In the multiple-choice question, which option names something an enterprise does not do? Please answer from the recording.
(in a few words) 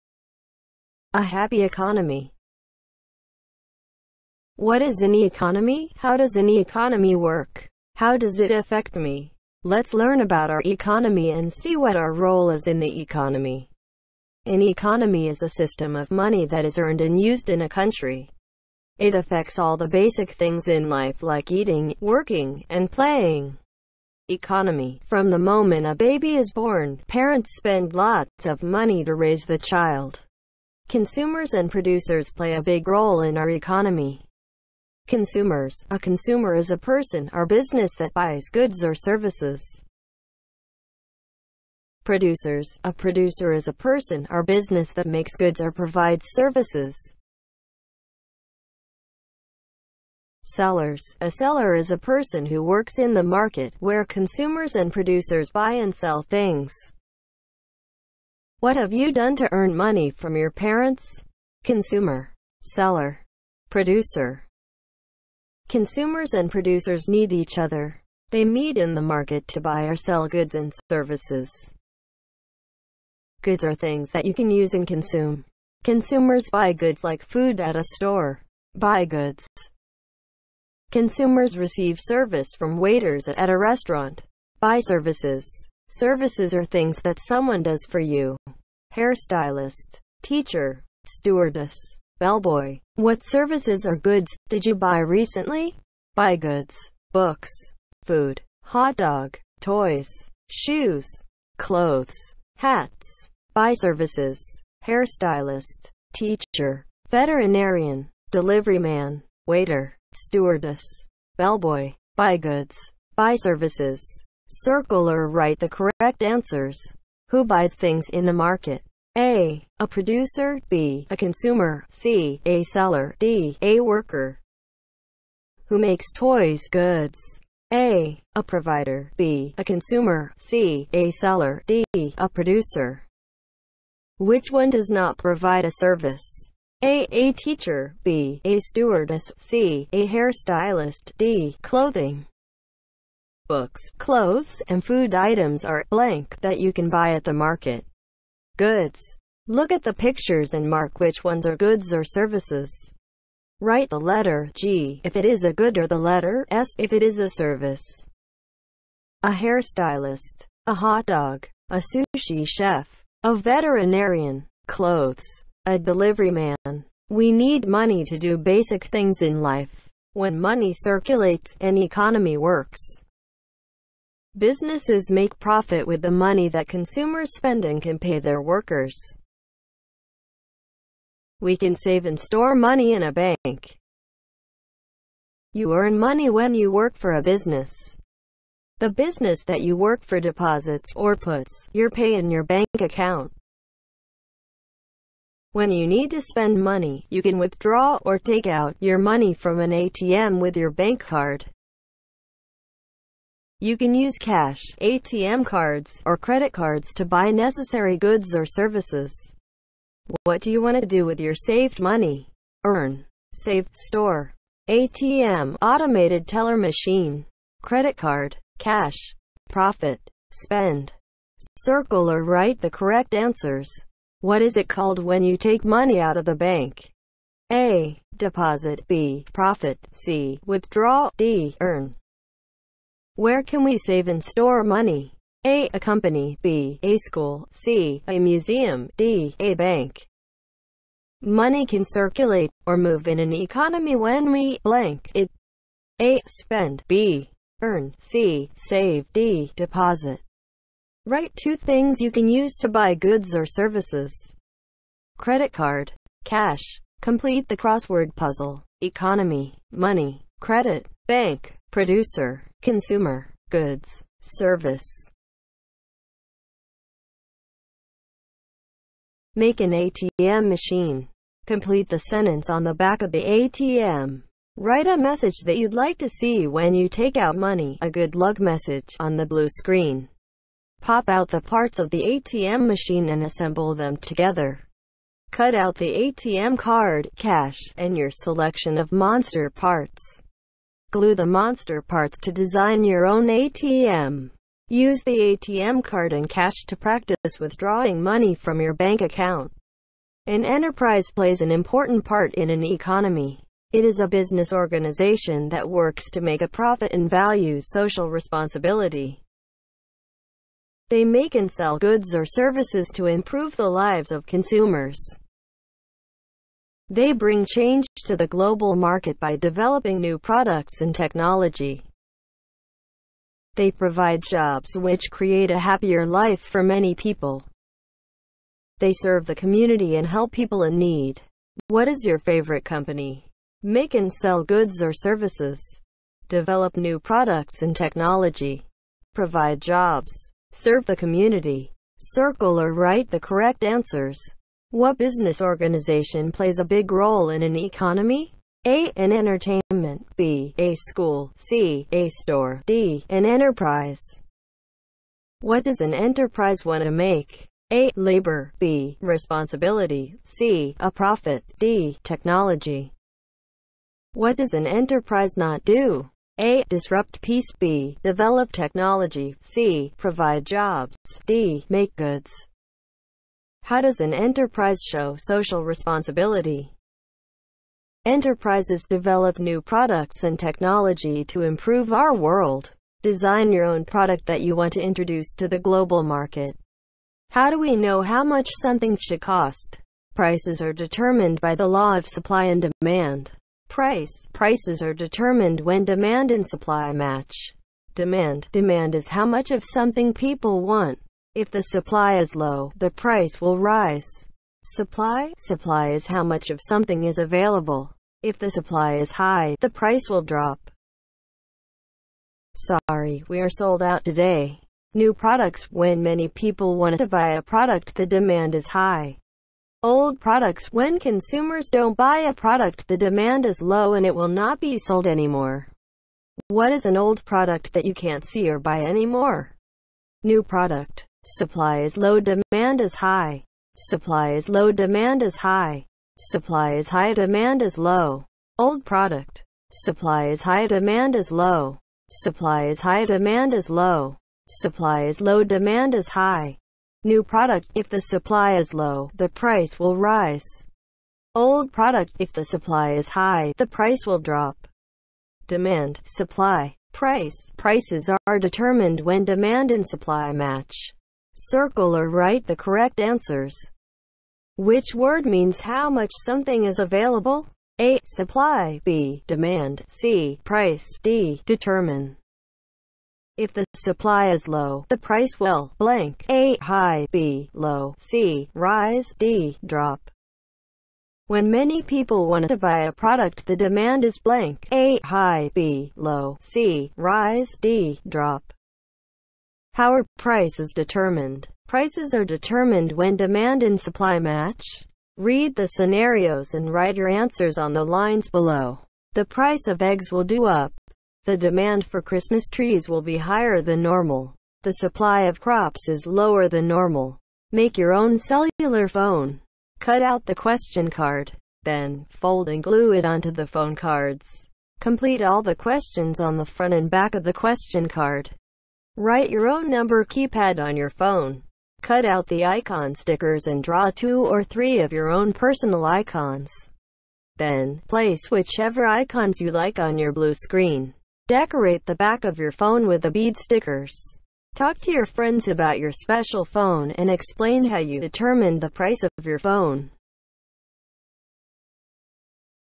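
Disrupt peace.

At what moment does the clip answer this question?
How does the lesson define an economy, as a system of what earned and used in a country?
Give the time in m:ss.
0:15.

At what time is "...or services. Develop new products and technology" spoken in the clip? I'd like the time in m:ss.
5:34.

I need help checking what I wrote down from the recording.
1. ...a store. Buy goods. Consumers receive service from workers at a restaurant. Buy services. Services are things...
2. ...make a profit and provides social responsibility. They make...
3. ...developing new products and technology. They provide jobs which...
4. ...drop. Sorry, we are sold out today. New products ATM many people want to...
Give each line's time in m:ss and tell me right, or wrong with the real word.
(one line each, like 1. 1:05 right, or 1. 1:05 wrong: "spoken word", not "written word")
1. 1:17 wrong: "waiters", not "workers"
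2. 5:06 wrong: "values", not "provides"
3. 5:19 right
4. 6:50 wrong: "When", not "ATM".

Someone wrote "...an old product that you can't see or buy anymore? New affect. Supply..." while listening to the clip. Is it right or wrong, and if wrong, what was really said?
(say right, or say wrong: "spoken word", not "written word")
wrong: "product", not "affect".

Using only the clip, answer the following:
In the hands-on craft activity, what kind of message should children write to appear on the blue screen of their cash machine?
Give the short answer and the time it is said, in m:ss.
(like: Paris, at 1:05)
A good luck message, at 4:37.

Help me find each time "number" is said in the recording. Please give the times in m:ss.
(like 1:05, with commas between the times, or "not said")
8:39.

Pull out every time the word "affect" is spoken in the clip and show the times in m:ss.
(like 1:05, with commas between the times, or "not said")
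0:08, 0:19.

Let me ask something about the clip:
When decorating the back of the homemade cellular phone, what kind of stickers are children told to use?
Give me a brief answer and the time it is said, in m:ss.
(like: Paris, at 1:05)
Bead stickers, at 8:53.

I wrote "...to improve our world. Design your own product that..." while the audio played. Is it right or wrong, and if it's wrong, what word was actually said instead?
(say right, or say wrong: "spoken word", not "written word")
right.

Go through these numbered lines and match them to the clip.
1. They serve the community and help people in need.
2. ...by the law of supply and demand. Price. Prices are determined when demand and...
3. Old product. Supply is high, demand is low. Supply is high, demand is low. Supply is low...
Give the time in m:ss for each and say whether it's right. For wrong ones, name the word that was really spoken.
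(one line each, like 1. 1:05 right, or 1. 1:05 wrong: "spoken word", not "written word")
1. 5:28 right
2. 6:31 right
3. 7:18 right.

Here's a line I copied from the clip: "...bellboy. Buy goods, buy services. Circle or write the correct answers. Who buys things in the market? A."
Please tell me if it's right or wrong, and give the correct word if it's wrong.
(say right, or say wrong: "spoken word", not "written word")
right.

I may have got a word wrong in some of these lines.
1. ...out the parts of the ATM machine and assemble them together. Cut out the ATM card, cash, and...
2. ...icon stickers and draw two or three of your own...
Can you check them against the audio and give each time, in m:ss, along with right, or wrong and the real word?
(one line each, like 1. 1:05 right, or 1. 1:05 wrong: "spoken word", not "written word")
1. 4:41 right
2. 8:42 right.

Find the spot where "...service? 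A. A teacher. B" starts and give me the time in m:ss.
2:15.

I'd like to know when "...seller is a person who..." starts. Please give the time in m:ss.
0:51.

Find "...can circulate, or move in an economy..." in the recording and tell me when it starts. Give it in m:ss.
4:01.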